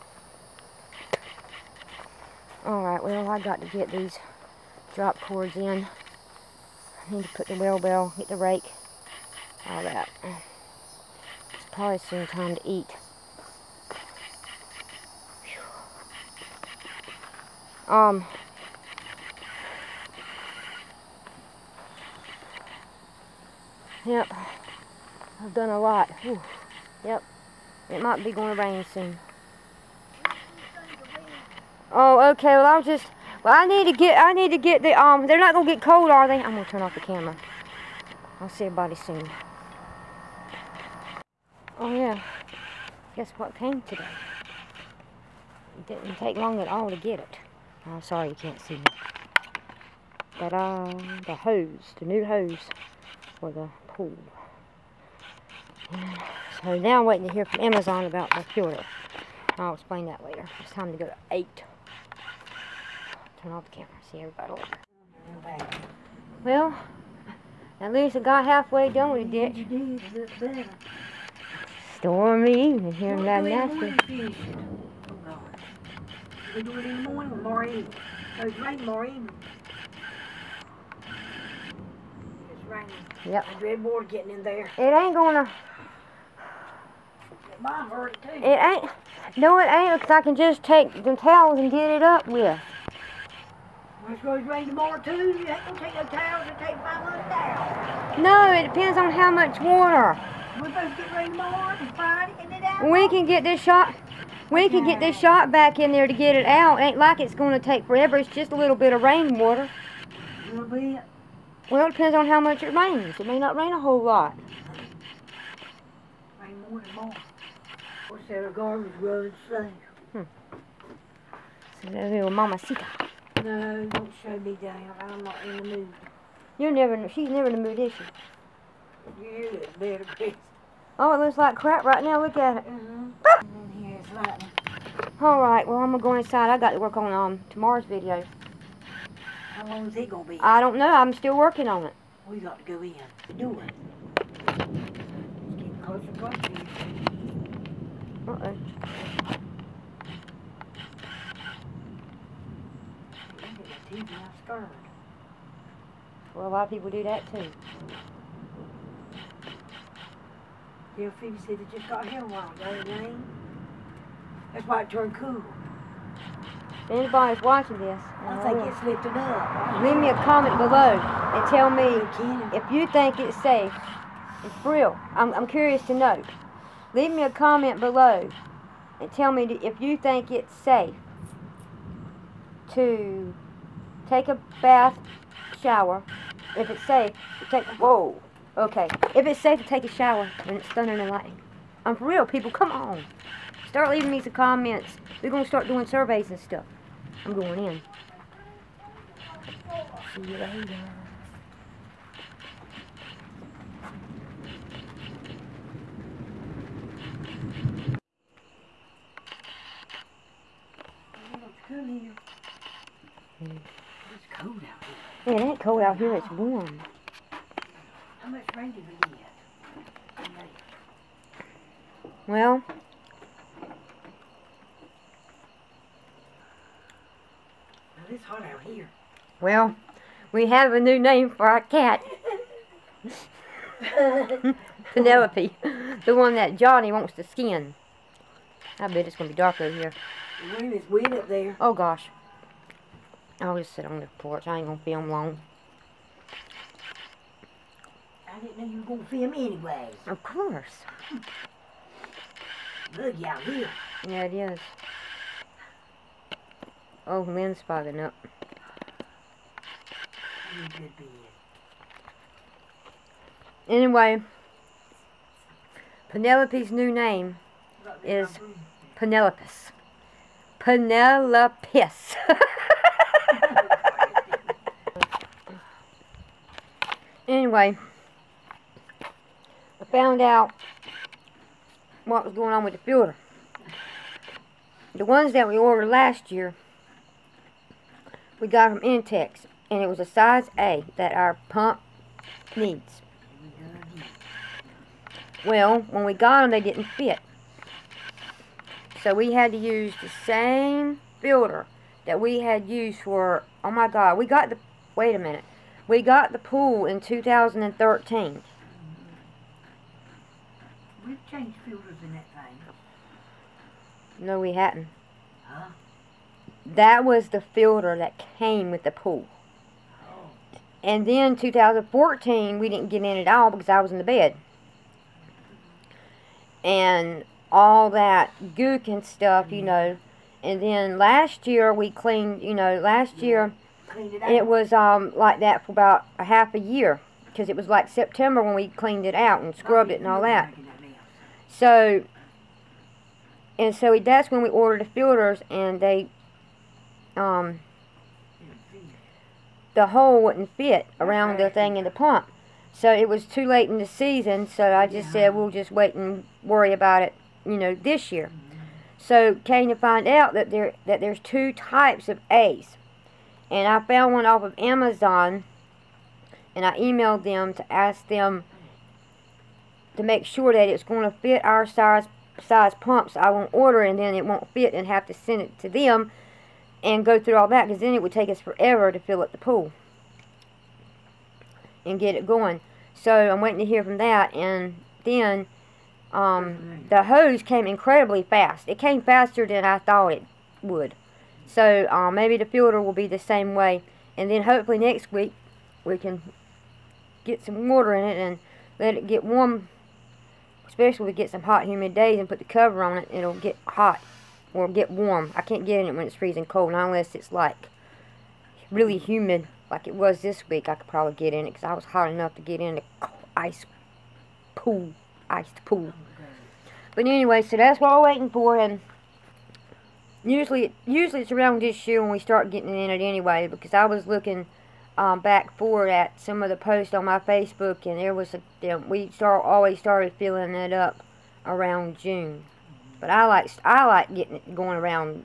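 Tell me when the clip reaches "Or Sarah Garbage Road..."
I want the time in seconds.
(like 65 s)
118 s.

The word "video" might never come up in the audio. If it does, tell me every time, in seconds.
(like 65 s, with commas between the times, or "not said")
137 s.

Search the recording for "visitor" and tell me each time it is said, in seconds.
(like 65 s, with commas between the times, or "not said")
not said.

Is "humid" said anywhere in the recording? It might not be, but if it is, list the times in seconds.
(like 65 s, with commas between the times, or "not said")
401 s, 408 s.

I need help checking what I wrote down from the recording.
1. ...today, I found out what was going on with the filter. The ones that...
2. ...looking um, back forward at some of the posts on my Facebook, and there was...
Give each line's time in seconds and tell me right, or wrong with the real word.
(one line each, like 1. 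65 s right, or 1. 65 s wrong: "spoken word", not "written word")
1. 277 s wrong: "anyway", not "today"
2. 424 s right.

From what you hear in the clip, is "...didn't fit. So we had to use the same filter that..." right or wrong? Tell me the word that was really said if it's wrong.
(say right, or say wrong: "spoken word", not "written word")
right.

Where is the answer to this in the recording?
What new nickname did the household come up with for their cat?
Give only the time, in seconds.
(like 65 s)
268 s.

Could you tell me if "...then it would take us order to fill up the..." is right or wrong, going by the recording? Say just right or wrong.
wrong.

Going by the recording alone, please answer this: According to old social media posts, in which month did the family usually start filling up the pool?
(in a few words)
June.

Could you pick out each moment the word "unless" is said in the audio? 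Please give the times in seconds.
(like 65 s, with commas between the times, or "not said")
406 s.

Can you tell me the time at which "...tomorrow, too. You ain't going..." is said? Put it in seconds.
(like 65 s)
94 s.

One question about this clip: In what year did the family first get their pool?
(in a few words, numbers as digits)
2013.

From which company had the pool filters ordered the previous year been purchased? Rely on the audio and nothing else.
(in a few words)
Intex.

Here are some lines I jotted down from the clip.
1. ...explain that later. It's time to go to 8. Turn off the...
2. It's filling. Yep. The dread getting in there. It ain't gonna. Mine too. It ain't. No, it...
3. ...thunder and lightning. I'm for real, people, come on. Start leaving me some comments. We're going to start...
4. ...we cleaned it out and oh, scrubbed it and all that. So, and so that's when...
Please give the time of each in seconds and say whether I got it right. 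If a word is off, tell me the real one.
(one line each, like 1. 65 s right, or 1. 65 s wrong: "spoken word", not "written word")
1. 59 s right
2. 82 s wrong: "raining", not "filling"
3. 190 s right
4. 338 s right.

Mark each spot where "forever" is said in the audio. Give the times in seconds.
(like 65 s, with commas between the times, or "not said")
107 s, 378 s.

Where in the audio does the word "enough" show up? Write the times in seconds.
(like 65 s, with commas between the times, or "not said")
412 s.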